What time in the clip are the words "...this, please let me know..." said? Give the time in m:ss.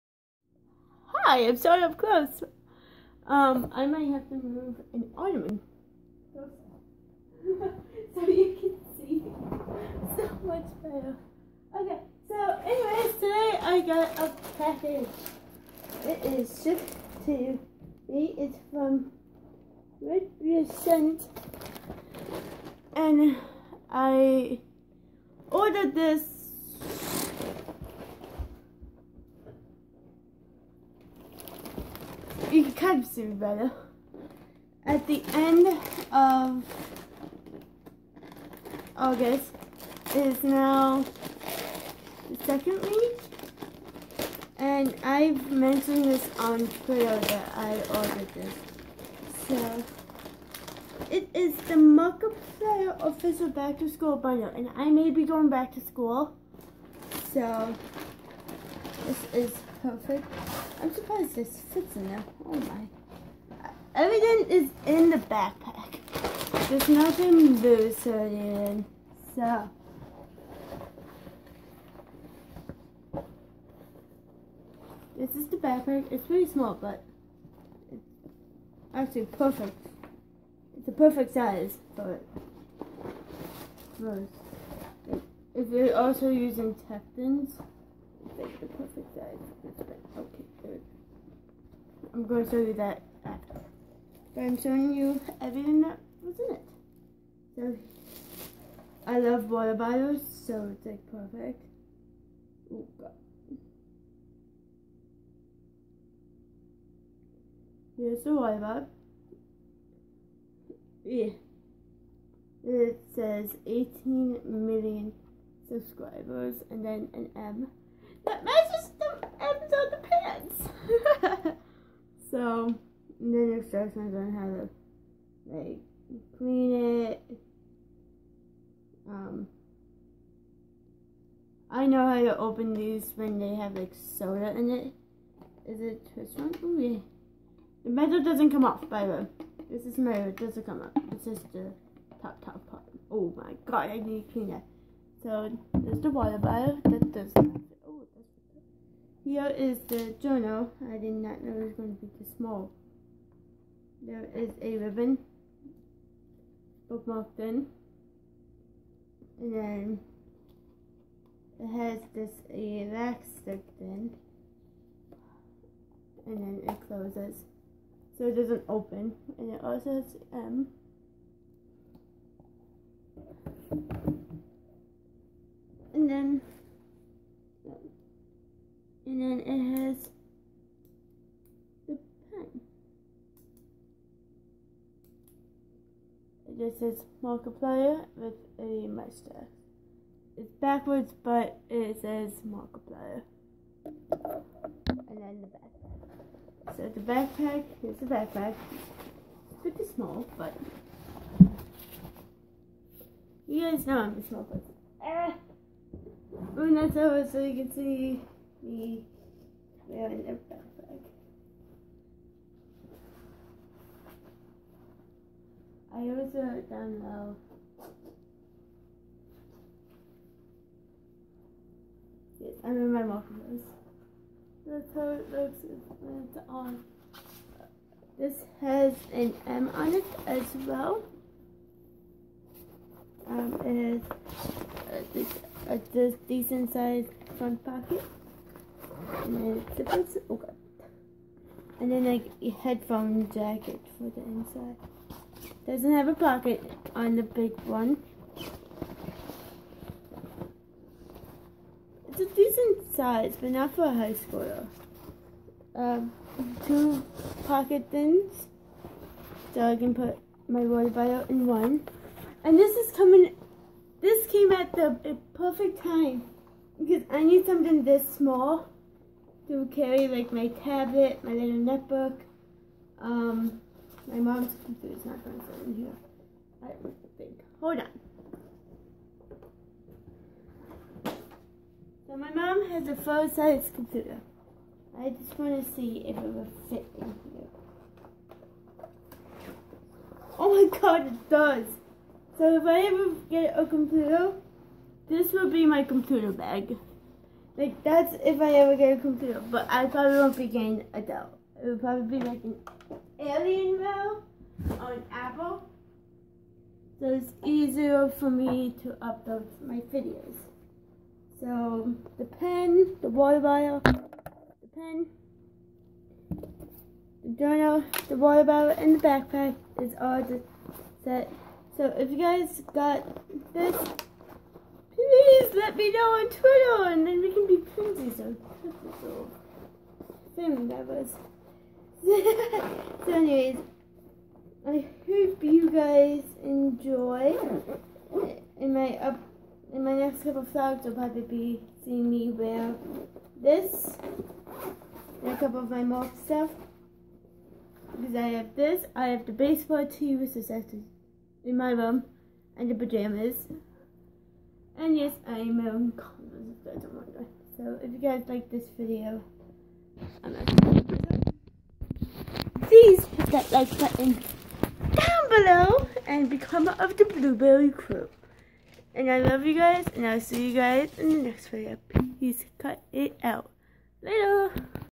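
5:23.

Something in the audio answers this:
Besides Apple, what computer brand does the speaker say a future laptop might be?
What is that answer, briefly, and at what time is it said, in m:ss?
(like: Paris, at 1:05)
Alienware, at 5:03.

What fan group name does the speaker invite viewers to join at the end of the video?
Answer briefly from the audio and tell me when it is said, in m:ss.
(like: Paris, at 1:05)
Blueberry Crew, at 6:07.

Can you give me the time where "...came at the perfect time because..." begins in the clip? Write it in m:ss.
4:24.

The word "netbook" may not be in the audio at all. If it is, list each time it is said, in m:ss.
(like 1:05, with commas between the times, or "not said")
4:31.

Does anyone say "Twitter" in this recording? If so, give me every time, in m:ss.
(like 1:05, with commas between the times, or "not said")
0:46, 5:26.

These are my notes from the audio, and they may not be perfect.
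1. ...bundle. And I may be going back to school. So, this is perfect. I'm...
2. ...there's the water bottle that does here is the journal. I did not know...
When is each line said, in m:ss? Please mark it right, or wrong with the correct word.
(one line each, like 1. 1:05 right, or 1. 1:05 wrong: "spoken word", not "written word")
1. 0:54 right
2. 2:25 right.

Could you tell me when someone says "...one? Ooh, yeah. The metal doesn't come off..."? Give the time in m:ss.
2:16.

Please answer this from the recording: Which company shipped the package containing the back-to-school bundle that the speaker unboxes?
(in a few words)
Red Sent.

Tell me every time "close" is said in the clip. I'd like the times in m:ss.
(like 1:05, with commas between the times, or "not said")
0:01, 2:46.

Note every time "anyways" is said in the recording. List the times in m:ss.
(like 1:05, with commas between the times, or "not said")
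0:12, 5:33.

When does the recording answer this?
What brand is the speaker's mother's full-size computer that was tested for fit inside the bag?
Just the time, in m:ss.
5:01.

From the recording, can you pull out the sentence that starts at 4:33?
Um, my mom's computer is not going to fit in here.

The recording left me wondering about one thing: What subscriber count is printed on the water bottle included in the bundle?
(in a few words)
18 million.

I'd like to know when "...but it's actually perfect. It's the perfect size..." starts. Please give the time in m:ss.
1:16.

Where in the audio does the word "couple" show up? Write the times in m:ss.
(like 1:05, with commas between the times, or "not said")
5:40, 5:45.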